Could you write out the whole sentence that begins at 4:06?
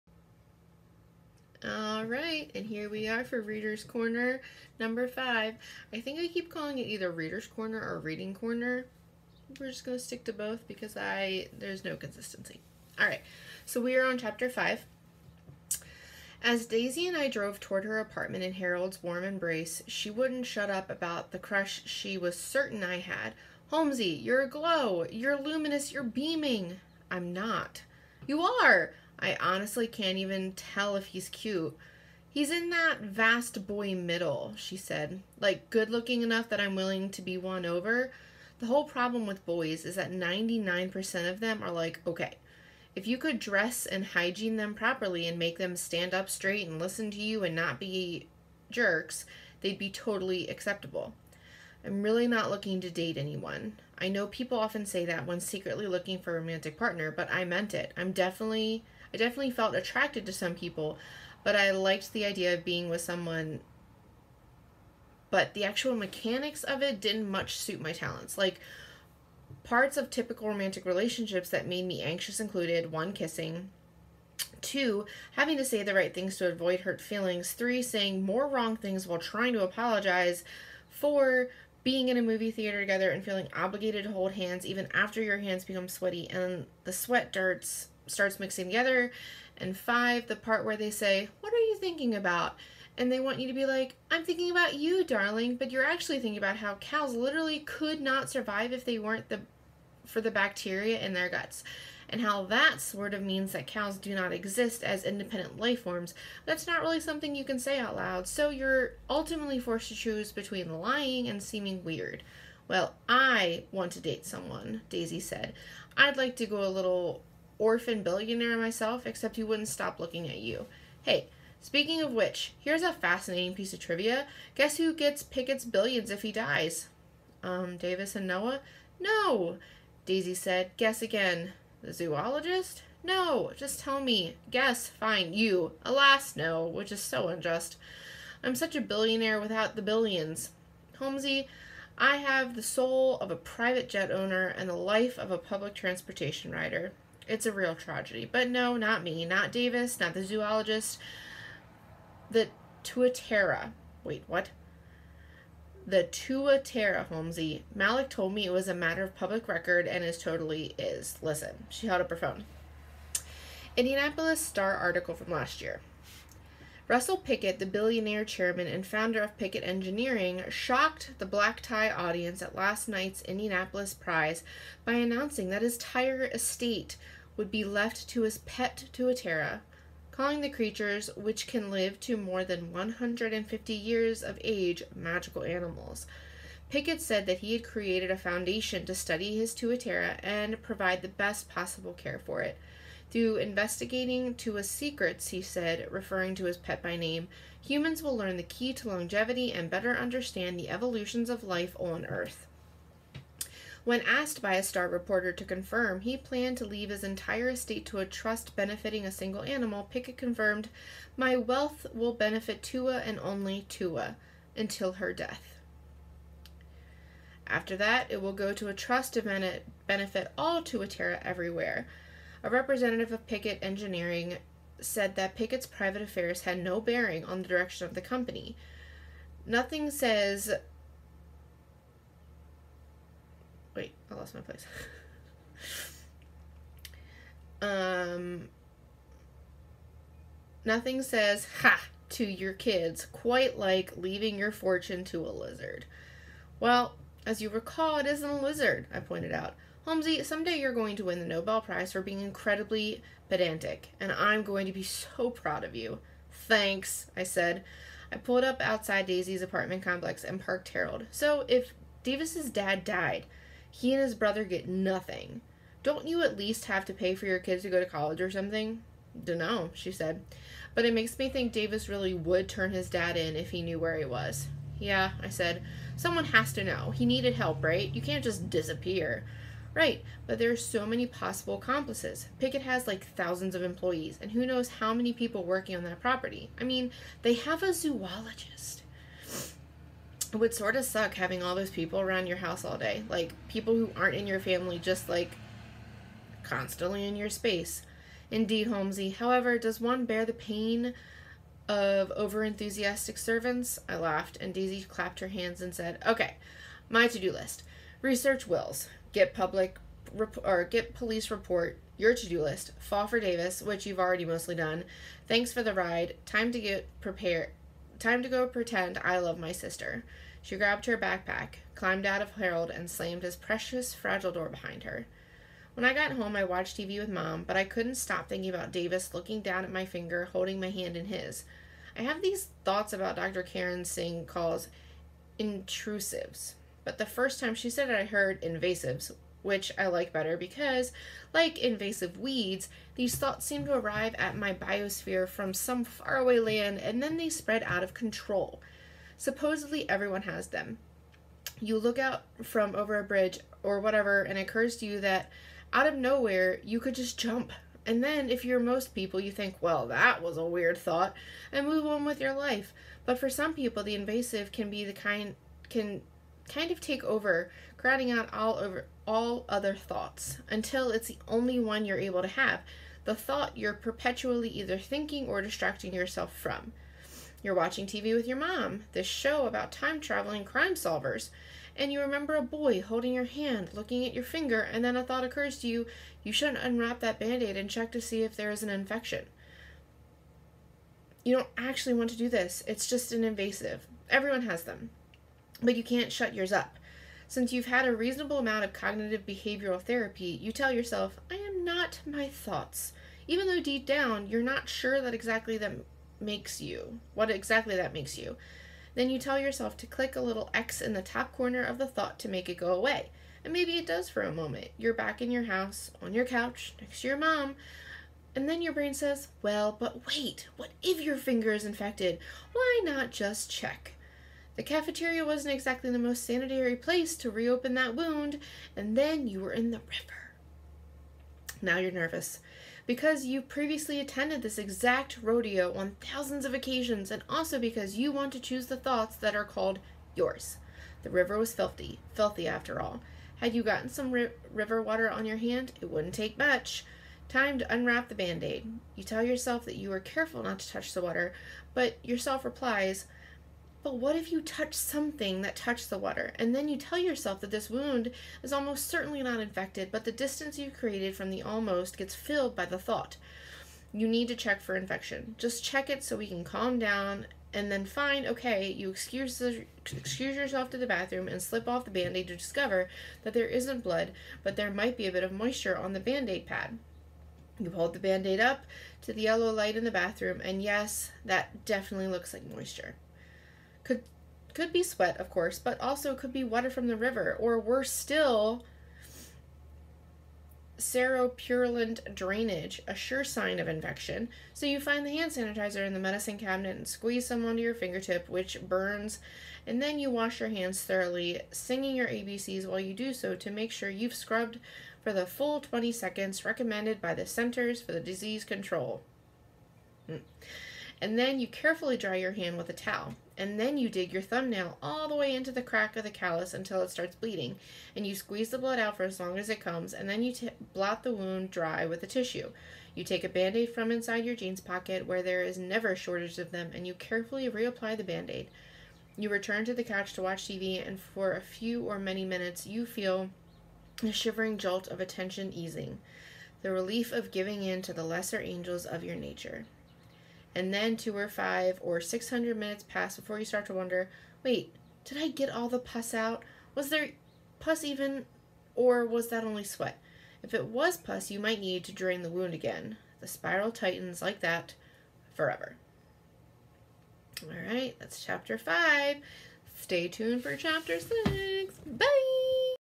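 Well, as you recall, it isn't a lizard, I pointed out.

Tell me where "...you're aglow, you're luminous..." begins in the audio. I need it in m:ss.
0:24.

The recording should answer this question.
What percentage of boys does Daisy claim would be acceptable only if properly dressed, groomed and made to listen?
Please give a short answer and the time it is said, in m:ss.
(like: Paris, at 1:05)
99%, at 0:40.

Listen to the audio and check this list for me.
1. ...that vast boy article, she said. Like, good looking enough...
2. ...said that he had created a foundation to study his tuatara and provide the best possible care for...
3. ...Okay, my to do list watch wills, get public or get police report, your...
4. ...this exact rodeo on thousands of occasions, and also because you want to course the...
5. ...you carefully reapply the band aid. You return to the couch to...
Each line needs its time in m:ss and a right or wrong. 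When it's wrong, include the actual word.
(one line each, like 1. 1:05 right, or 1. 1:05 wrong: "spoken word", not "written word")
1. 0:32 wrong: "middle", not "article"
2. 3:07 right
3. 5:06 wrong: "research", not "watch"
4. 7:14 wrong: "choose", not "course"
5. 8:46 right.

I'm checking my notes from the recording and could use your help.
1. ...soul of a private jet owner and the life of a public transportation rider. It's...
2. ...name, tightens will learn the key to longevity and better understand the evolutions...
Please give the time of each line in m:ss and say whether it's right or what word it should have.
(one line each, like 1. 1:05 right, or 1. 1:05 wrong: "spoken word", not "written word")
1. 2:22 right
2. 3:16 wrong: "humans", not "tightens".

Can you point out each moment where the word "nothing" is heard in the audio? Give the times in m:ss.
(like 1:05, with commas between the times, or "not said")
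3:49, 4:00, 4:24.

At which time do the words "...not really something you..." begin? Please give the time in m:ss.
1:46.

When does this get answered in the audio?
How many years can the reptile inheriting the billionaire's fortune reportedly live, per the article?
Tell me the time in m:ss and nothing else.
3:02.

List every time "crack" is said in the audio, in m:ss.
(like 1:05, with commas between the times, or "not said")
8:35.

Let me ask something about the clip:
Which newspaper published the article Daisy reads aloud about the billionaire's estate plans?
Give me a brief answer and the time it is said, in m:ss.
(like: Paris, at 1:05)
Indianapolis Star, at 2:43.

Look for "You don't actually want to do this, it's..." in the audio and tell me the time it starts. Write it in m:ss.
6:31.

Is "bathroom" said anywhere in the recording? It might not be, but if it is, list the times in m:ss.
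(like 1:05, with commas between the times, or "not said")
7:50, 7:59.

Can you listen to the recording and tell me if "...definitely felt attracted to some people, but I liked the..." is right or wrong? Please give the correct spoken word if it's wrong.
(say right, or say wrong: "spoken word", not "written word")
right.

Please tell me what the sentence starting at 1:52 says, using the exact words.
Well, I want to date someone, Daisy said.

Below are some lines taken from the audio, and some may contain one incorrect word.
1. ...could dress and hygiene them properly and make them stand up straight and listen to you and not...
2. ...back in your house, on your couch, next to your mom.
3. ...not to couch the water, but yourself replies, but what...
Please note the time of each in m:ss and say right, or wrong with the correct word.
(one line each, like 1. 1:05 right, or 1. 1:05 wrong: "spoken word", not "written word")
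1. 0:43 right
2. 6:54 right
3. 7:30 wrong: "touch", not "couch".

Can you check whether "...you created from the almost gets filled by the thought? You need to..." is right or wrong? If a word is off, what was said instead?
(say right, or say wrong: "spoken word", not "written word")
right.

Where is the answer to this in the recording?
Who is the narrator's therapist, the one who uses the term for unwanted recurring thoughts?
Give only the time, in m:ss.
5:33.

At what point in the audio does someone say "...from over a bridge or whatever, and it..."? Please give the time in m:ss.
5:52.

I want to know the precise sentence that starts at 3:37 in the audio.
After that, it will go to a trust to benefit all Tuatara everywhere.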